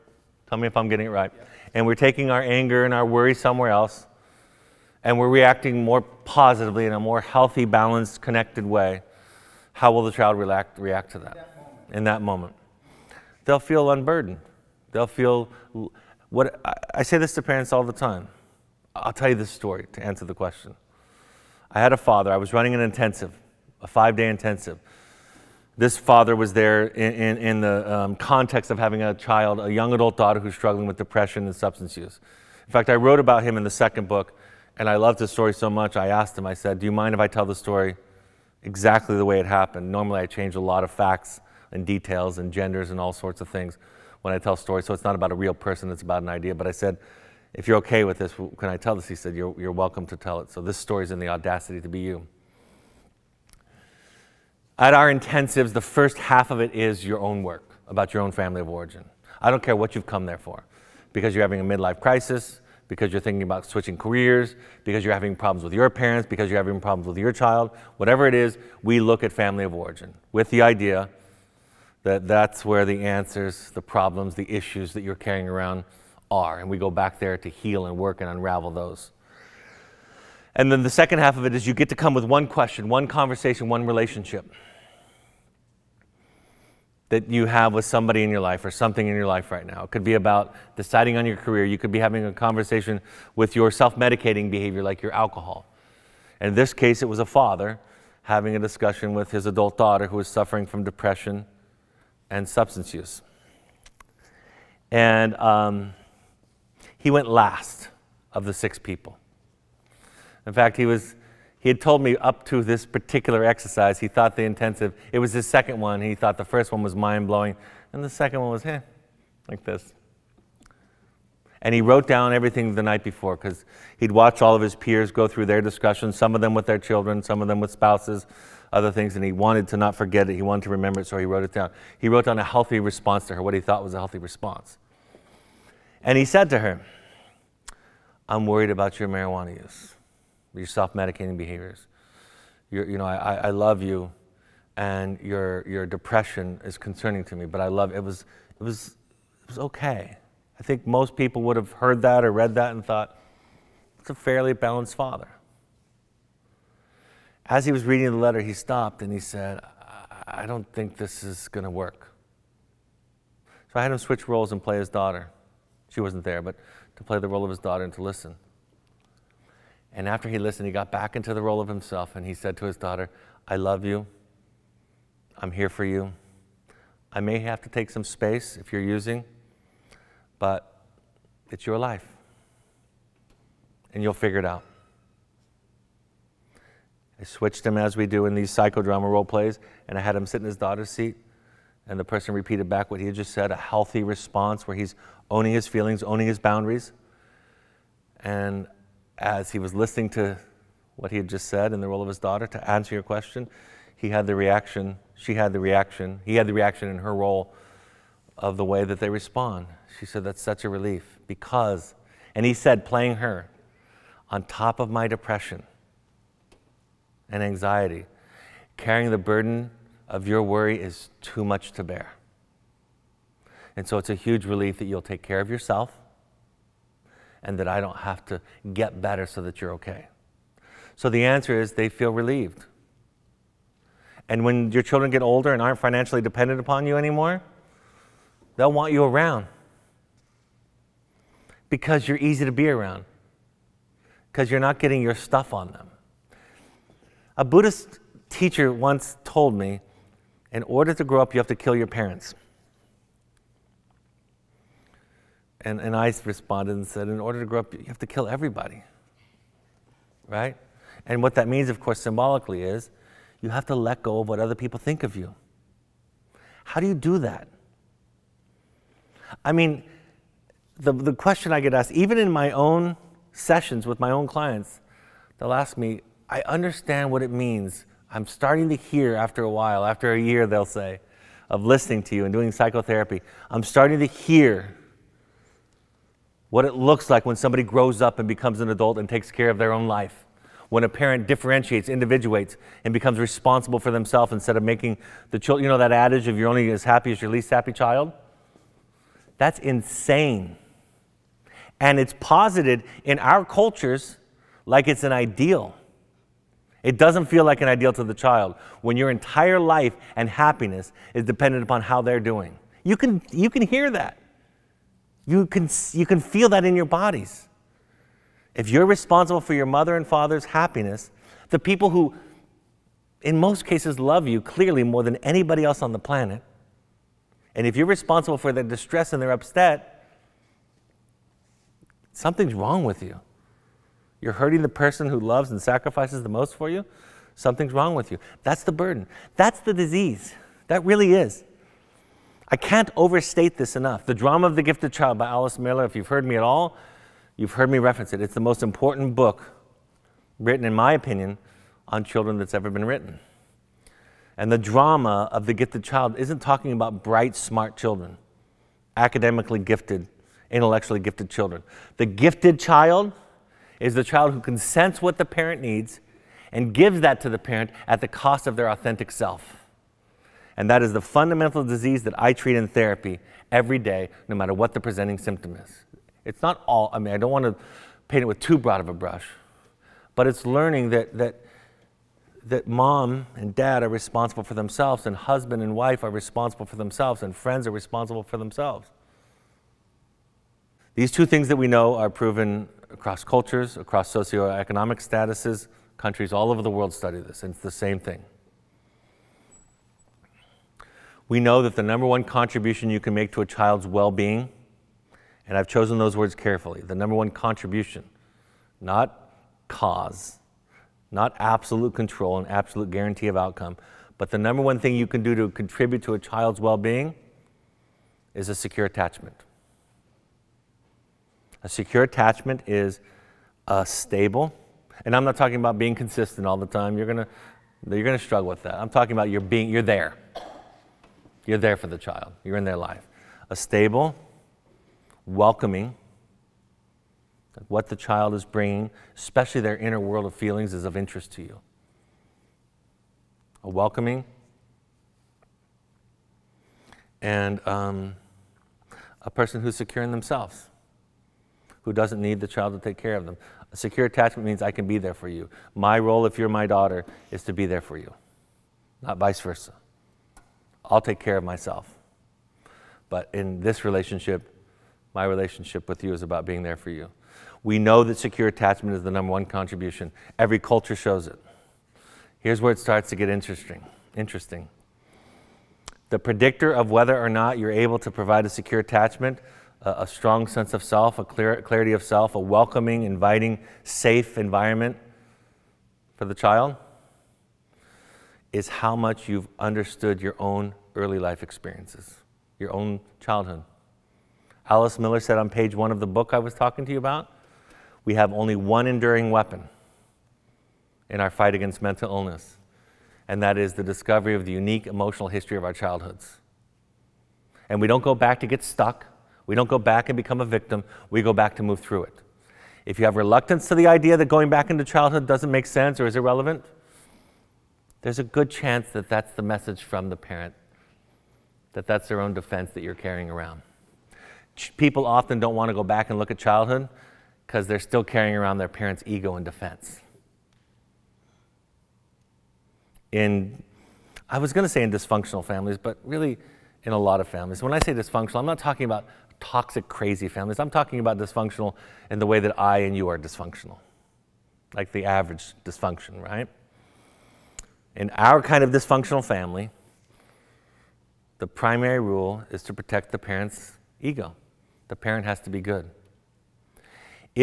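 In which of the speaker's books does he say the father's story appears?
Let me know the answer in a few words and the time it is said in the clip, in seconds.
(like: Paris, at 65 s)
The Audacity to Be You, at 51 s.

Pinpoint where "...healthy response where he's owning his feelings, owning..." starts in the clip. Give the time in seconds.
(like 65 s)
193 s.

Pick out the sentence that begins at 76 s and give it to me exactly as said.
And we go back there to heal and work and unravel those.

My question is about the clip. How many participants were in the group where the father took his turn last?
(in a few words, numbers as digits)
6.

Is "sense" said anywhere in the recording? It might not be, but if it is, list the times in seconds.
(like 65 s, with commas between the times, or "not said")
364 s, 480 s, 515 s.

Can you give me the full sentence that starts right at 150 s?
I think most people would have heard that or read that and thought, it's a fairly balanced father.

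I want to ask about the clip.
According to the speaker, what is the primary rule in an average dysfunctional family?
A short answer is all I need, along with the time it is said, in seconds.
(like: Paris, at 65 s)
Protect the parent's ego, at 552 s.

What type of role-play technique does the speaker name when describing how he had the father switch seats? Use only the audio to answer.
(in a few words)
Psychodrama.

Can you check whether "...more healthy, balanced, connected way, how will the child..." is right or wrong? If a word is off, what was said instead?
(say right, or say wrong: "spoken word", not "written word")
right.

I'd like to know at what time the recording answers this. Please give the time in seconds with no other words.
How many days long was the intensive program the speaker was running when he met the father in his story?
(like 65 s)
23 s.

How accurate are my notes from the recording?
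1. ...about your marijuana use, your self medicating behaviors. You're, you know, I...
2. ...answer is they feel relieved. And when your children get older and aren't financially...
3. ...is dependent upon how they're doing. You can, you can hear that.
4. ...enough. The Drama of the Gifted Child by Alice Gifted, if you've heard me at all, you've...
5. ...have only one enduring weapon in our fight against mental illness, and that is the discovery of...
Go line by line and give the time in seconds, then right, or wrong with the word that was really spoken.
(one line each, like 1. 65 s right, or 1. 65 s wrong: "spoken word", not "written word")
1. 138 s right
2. 231 s right
3. 311 s right
4. 343 s wrong: "Miller", not "Gifted"
5. 498 s right.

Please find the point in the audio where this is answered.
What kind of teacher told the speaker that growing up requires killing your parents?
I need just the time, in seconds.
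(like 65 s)
247 s.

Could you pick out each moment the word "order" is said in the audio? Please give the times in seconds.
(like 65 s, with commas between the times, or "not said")
250 s, 257 s.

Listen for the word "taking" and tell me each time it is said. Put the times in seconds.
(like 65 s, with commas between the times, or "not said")
1 s.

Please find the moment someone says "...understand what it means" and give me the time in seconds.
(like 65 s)
276 s.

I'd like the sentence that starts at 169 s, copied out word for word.
And after he listened, he got back into the role of himself and he said to his daughter, I love you.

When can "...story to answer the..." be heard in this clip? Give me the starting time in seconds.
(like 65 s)
19 s.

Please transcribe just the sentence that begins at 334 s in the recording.
You're hurting the person who loves and sacrifices the most for you.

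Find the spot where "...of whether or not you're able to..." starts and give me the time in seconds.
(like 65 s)
476 s.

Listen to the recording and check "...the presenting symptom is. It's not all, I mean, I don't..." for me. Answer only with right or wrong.
right.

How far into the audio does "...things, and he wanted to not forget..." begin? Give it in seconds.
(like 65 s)
128 s.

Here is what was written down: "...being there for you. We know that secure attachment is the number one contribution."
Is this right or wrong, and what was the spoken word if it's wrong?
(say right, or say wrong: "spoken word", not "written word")
right.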